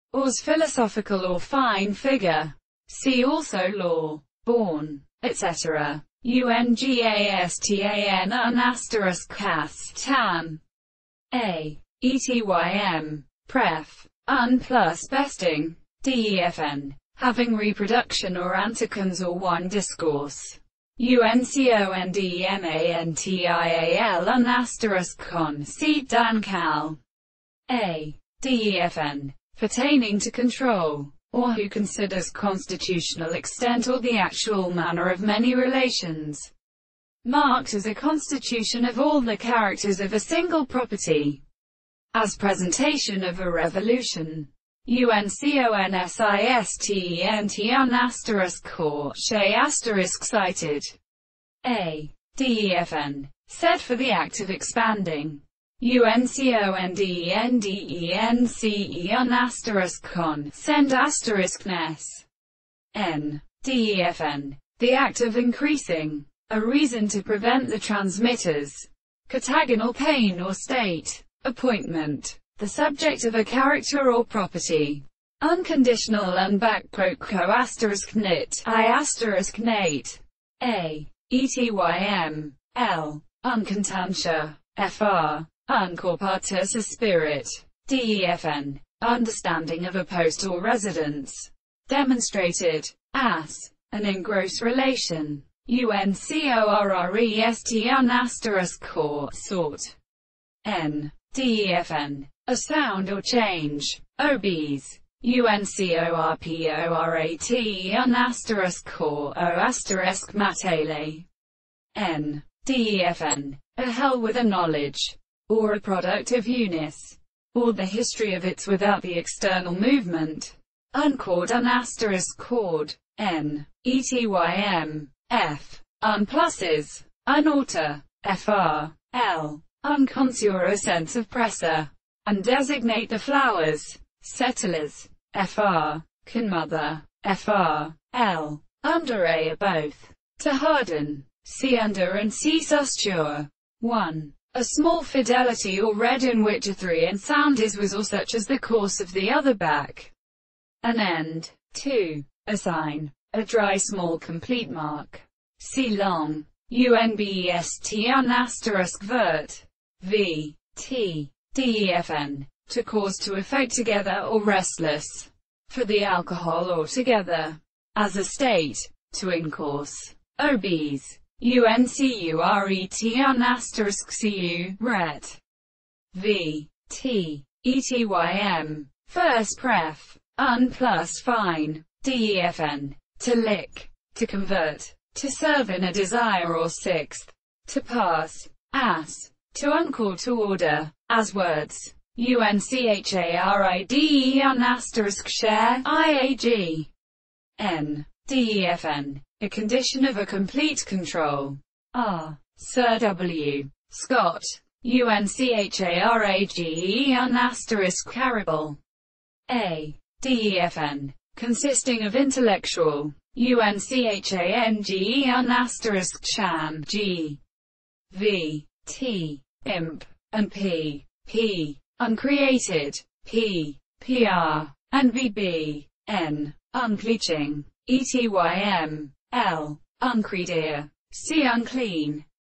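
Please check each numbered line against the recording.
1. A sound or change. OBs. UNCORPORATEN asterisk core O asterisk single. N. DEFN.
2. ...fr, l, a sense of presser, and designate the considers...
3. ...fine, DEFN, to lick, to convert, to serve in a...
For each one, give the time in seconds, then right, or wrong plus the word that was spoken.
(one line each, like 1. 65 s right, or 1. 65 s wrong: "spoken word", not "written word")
1. 102 s wrong: "matele", not "single"
2. 128 s wrong: "flowers", not "considers"
3. 181 s right.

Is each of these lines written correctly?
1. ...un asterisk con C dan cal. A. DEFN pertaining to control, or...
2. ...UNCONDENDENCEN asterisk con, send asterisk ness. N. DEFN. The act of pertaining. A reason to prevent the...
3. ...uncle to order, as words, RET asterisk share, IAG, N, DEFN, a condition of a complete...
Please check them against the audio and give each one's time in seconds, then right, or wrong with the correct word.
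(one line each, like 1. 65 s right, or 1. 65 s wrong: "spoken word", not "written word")
1. 24 s right
2. 55 s wrong: "increasing", not "pertaining"
3. 189 s wrong: "UNCHARIDEN", not "RET".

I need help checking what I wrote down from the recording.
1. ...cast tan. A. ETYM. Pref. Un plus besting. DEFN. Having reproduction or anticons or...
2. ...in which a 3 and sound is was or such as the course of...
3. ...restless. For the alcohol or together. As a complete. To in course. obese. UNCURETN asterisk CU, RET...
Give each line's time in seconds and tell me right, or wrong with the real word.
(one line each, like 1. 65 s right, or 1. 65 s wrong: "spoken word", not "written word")
1. 9 s right
2. 146 s right
3. 164 s wrong: "state", not "complete".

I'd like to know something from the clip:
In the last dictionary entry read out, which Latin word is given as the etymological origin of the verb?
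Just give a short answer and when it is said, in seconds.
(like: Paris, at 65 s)
Uncredere, at 230 s.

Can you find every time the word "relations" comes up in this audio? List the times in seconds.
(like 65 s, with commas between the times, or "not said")
35 s, 94 s.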